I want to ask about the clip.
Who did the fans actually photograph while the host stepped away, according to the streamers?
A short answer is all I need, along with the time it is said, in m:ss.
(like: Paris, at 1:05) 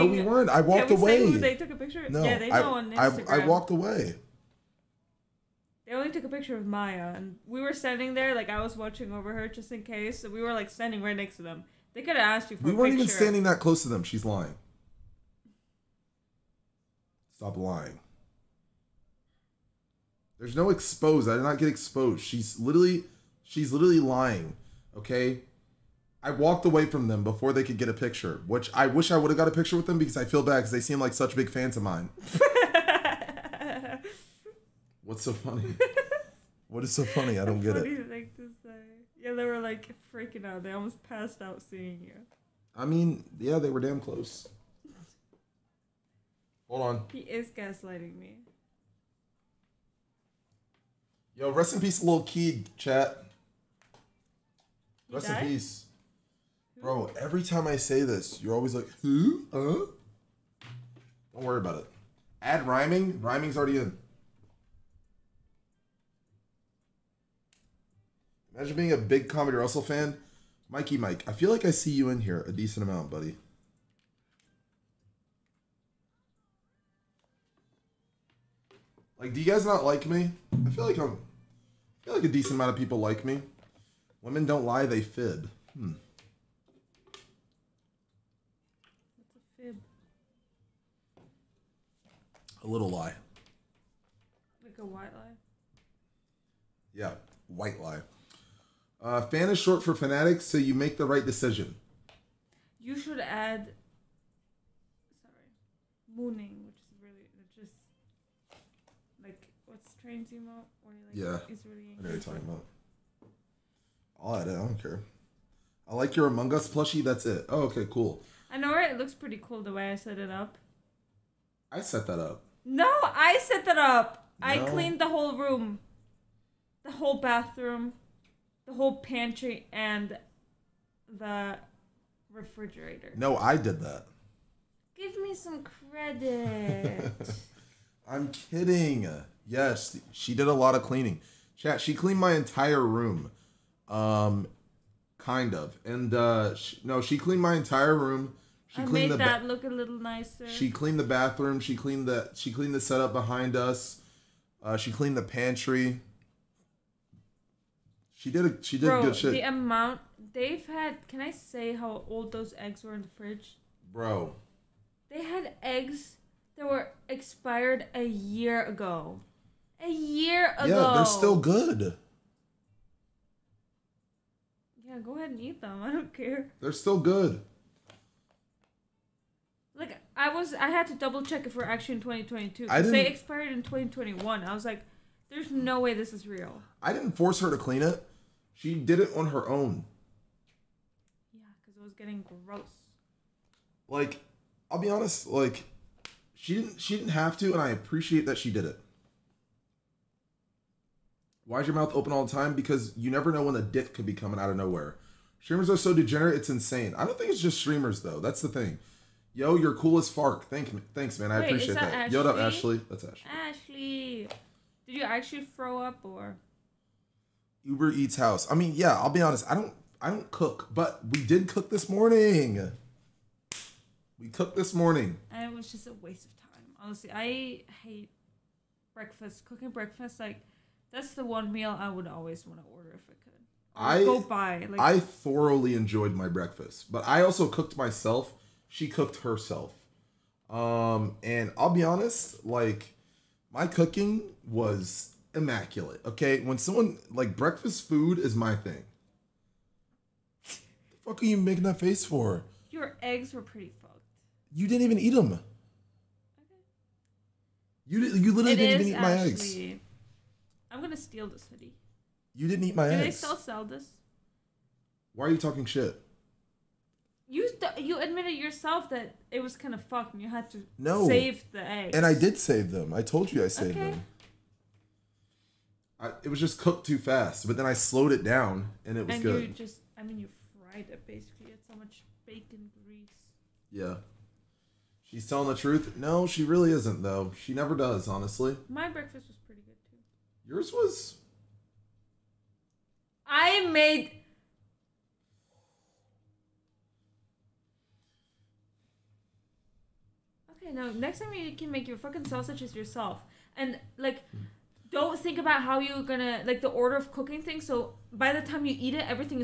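Maya, at 0:06.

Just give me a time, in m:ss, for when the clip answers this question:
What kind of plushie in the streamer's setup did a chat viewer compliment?
1:56.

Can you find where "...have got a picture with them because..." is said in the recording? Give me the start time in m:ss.
0:29.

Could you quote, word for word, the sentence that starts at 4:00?
Um, and I'll be honest, like my cooking was immaculate.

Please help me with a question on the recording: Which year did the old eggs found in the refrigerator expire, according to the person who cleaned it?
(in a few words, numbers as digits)
2021.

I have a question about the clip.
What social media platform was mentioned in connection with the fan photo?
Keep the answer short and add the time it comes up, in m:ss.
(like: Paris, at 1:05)
Instagram, at 0:02.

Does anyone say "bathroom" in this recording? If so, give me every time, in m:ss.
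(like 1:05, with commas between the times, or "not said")
2:07, 2:31.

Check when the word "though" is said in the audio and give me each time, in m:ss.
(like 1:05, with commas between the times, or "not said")
3:28, 4:47.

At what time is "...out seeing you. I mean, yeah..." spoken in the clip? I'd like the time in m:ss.
0:41.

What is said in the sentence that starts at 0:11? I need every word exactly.
They could have asked you for.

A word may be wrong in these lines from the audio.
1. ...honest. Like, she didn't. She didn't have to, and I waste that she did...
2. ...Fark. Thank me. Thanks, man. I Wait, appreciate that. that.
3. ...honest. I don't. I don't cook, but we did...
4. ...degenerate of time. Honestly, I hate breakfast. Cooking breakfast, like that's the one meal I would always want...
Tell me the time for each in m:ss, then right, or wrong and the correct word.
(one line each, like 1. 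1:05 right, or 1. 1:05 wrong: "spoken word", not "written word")
1. 3:14 wrong: "appreciate", not "waste"
2. 3:30 right
3. 3:39 right
4. 3:46 wrong: "waste", not "degenerate".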